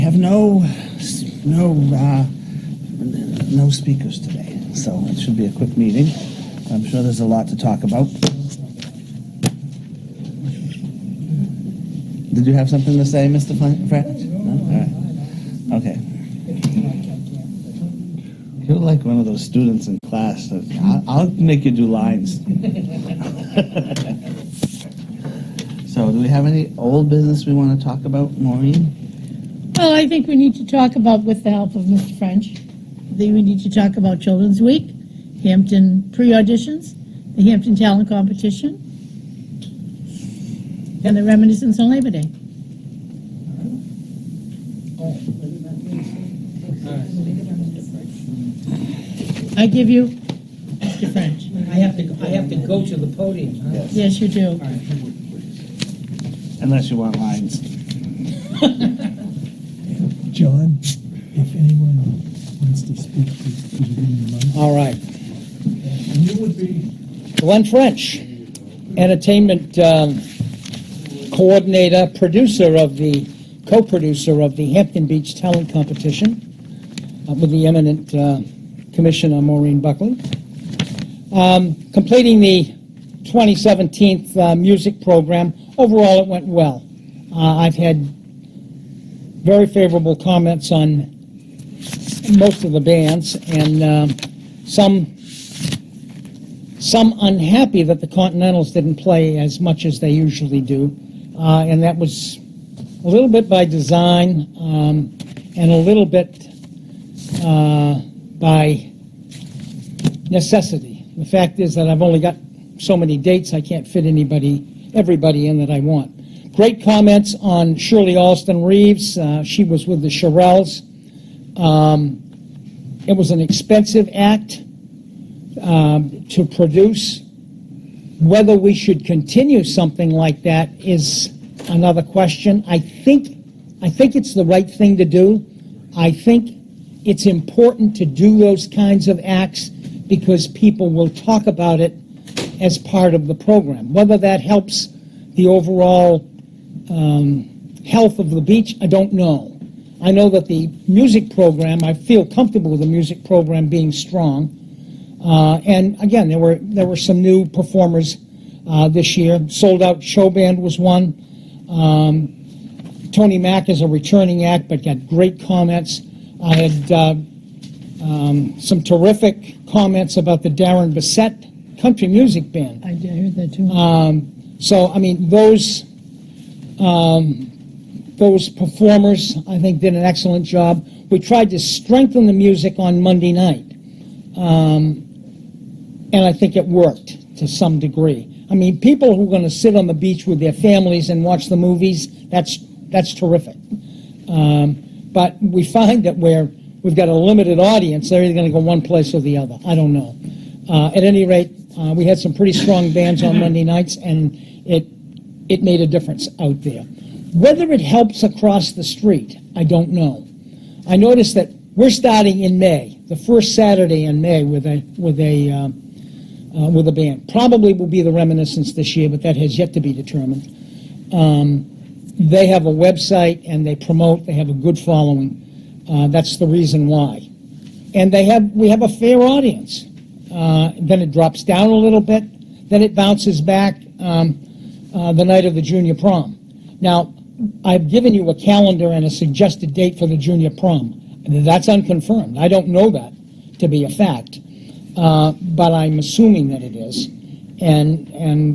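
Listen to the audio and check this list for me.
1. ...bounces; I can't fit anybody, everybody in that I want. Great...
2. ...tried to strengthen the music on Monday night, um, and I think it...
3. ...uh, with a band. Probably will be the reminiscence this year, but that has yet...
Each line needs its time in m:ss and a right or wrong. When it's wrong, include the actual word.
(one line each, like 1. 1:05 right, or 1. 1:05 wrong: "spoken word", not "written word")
1. 1:53 wrong: "dates", not "bounces"
2. 3:01 right
3. 3:36 right.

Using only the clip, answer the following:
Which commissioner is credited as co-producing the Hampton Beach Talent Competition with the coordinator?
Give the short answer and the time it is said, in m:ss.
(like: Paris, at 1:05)
Maureen Buckley, at 1:19.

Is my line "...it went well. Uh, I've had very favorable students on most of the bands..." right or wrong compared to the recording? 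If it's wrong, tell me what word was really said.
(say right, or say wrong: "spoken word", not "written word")
wrong: "comments", not "students".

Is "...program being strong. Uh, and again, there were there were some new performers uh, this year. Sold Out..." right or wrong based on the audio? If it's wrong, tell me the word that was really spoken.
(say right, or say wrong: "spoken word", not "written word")
right.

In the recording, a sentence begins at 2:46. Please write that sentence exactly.
I had uh, um, some terrific comments about the Darren Bissett Country Music Band.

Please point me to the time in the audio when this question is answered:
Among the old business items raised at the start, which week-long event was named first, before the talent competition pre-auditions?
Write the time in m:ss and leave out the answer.
0:34.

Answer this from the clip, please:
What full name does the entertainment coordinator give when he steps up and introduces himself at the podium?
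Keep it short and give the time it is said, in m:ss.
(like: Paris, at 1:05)
Glenn French, at 1:07.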